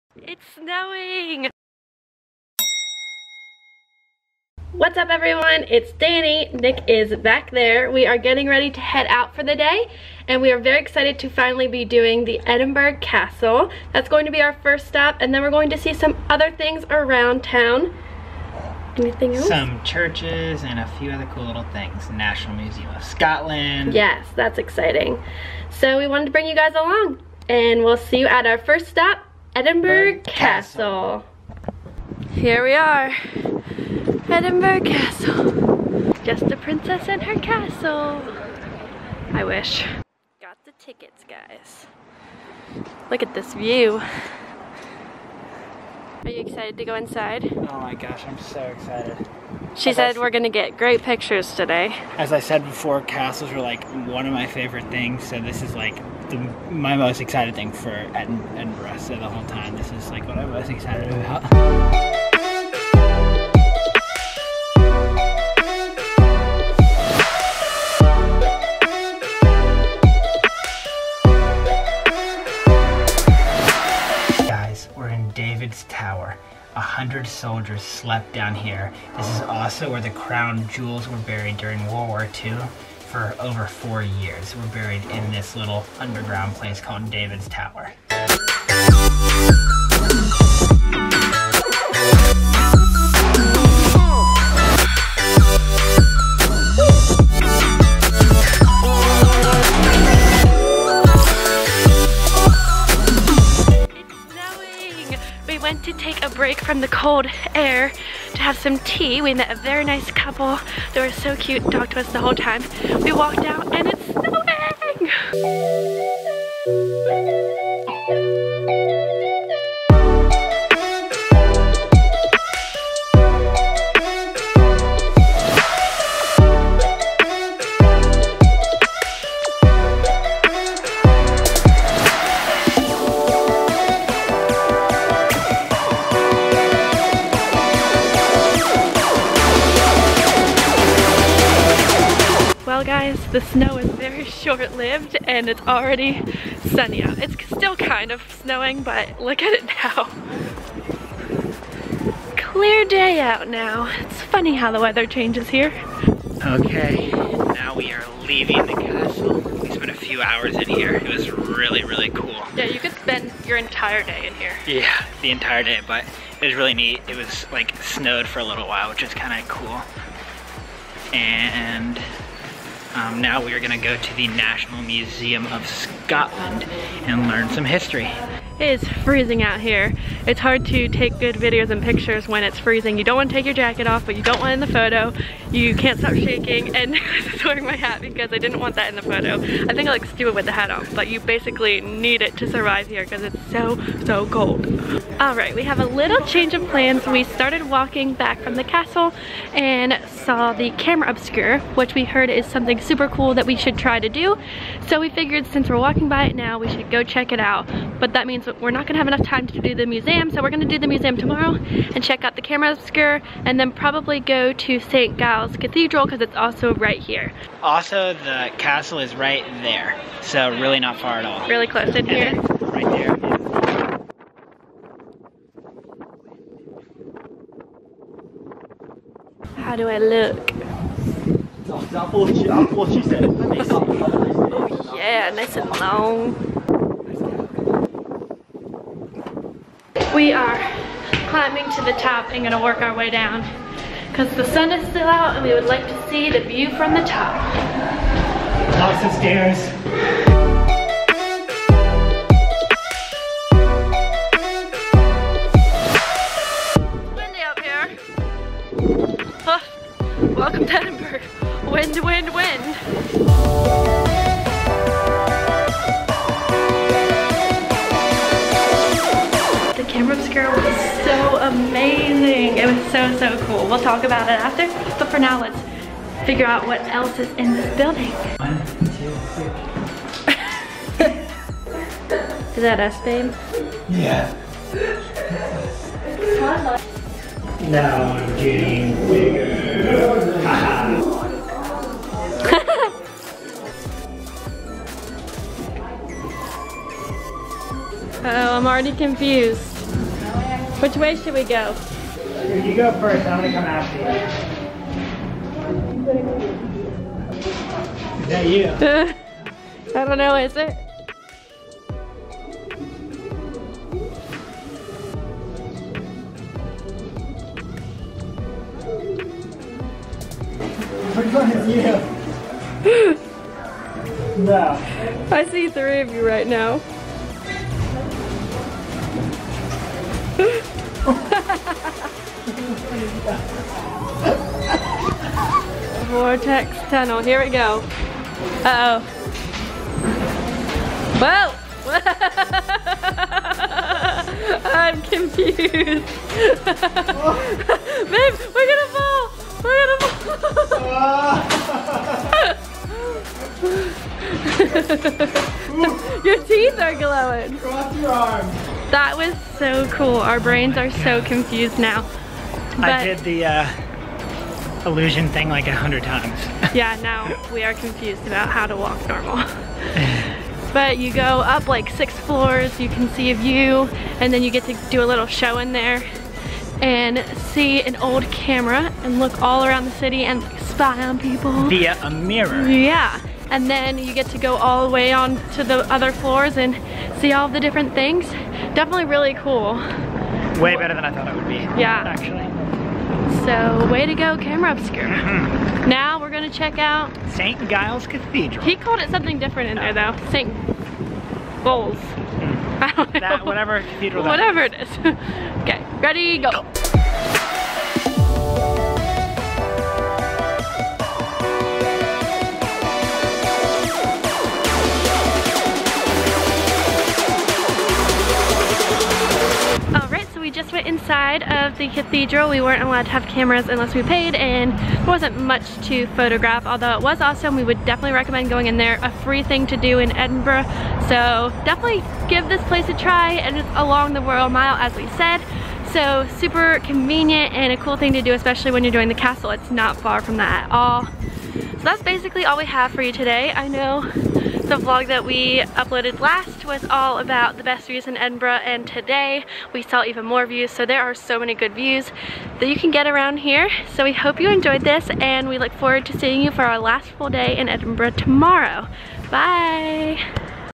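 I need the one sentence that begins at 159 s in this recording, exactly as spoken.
We spent a few hours in here.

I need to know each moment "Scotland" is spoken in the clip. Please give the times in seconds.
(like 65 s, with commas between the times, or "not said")
23 s, 175 s.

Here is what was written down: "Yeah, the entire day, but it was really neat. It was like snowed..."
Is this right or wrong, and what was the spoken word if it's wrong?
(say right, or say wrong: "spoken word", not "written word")
right.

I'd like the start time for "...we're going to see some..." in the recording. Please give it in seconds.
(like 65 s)
15 s.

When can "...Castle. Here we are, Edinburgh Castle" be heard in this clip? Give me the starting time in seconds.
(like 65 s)
30 s.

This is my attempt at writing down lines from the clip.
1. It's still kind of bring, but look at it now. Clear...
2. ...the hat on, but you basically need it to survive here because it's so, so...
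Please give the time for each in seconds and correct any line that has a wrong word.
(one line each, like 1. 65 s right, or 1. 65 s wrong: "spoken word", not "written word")
1. 147 s wrong: "snowing", not "bring"
2. 190 s right.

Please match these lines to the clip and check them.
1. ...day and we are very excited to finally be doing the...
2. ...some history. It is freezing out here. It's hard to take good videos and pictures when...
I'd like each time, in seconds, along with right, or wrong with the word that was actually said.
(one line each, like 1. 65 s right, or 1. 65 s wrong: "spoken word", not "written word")
1. 9 s right
2. 177 s right.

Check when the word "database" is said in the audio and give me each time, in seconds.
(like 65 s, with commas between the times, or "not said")
not said.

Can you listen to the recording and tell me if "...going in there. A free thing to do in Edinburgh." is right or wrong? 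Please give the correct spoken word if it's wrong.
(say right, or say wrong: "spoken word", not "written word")
right.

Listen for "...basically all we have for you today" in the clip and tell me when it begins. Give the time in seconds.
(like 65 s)
442 s.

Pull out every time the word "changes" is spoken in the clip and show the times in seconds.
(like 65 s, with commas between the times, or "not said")
155 s, 196 s.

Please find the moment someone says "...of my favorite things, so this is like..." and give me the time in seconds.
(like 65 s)
54 s.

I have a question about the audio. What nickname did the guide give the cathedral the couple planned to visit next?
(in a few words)
St. Bowls.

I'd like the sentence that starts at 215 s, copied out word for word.
Giles Cathedral because it's also right here.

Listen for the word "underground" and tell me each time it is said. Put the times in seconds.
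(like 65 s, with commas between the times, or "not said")
85 s.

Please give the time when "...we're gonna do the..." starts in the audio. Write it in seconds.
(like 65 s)
210 s.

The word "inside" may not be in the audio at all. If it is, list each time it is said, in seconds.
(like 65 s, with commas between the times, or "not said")
46 s, 420 s.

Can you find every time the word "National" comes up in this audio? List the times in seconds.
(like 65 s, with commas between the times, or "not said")
22 s, 174 s.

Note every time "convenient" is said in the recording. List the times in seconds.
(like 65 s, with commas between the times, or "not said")
436 s.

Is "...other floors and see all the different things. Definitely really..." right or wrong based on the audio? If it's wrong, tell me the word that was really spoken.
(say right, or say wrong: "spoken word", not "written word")
right.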